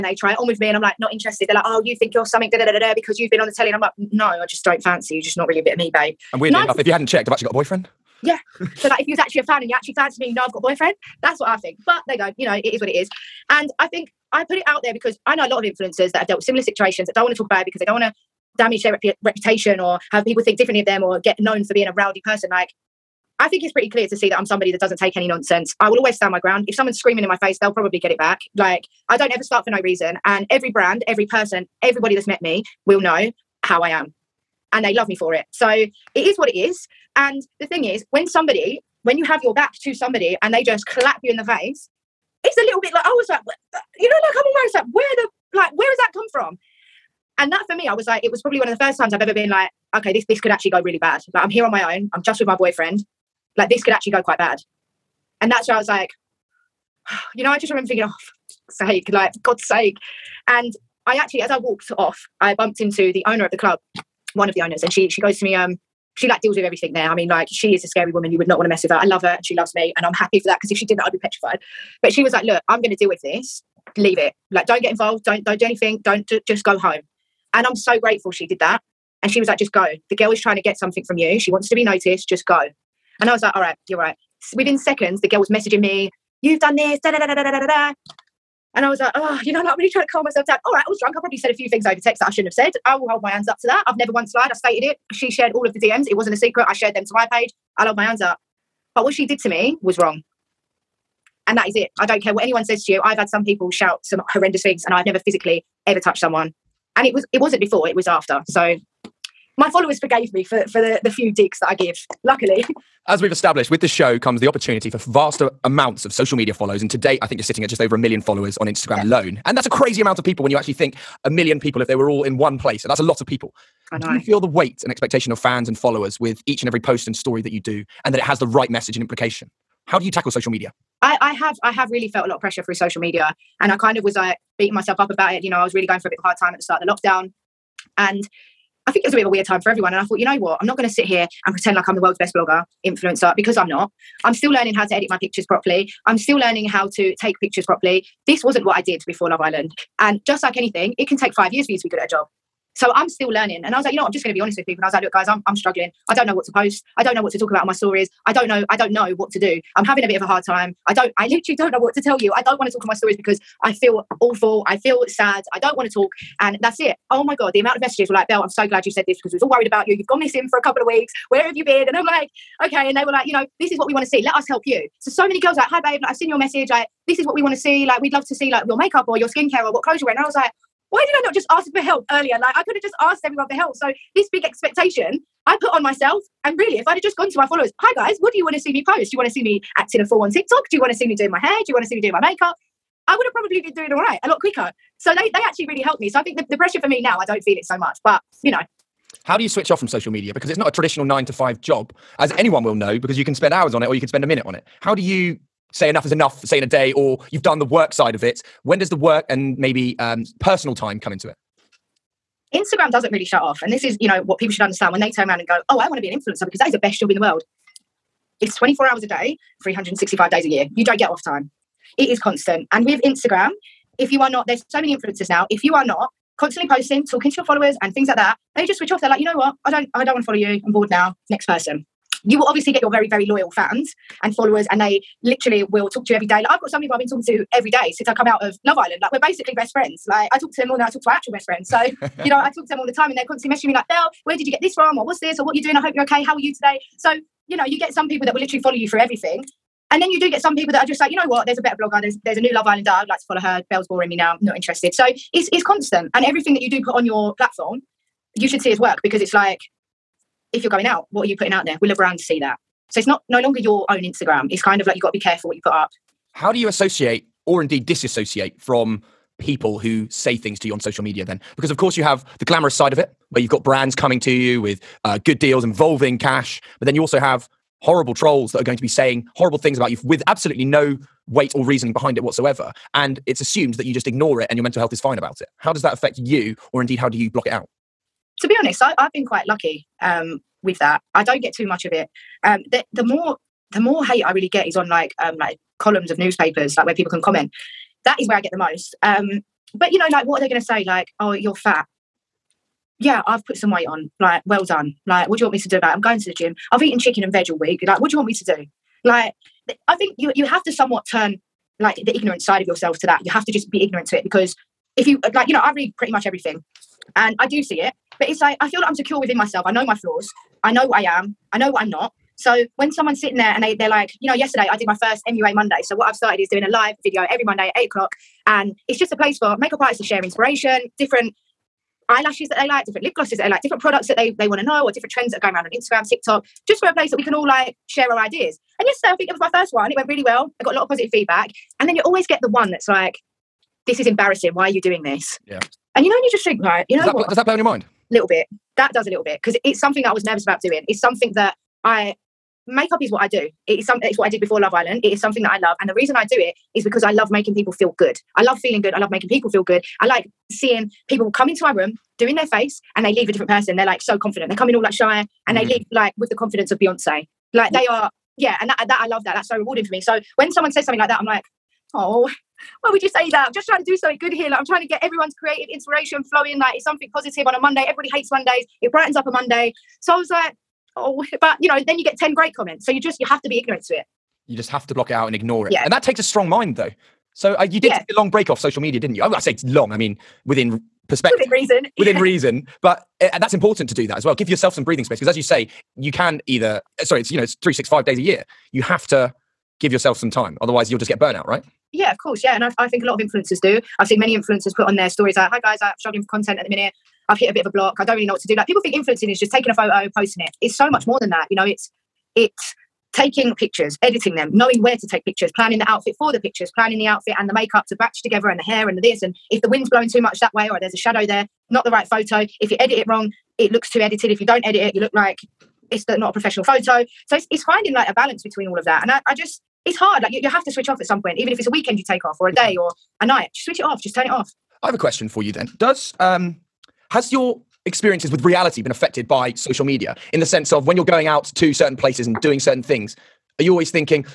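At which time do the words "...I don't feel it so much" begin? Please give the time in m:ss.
3:17.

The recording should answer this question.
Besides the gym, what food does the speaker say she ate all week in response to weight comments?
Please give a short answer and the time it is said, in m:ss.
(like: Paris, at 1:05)
Chicken and veg, at 5:06.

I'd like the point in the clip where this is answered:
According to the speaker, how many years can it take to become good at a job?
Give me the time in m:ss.
2:31.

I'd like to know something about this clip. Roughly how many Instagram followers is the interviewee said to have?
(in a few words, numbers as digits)
Just over a million.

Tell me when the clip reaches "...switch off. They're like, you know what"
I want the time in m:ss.
3:48.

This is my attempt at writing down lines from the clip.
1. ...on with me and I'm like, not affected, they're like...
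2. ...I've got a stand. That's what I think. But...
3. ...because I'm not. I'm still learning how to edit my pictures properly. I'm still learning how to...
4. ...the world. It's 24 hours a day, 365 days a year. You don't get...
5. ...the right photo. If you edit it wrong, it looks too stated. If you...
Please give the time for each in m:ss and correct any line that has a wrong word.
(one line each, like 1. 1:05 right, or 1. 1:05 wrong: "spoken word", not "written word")
1. 0:00 wrong: "interested", not "affected"
2. 0:10 wrong: "boyfriend", not "stand"
3. 2:23 right
4. 3:37 right
5. 7:01 wrong: "edited", not "stated".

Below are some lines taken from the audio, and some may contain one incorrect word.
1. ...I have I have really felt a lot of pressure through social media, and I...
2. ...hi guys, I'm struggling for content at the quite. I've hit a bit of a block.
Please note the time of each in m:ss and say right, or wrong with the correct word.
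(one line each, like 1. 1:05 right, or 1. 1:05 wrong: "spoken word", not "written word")
1. 2:11 right
2. 6:45 wrong: "minute", not "quite".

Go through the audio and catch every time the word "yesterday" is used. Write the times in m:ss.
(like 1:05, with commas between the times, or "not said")
5:24, 5:38.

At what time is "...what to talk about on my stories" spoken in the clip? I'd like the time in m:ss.
2:37.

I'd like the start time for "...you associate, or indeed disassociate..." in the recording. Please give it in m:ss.
4:26.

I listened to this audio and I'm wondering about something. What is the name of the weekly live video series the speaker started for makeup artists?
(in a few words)
MUA Monday.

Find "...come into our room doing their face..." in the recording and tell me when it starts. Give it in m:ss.
6:01.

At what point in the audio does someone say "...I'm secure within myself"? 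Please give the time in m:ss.
5:18.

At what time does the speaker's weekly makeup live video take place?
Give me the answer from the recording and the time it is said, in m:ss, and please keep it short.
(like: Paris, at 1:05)
8 o'clock, at 5:27.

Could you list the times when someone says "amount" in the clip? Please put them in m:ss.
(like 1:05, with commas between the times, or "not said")
1:55, 2:00, 2:47.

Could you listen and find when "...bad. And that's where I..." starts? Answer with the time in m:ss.
0:54.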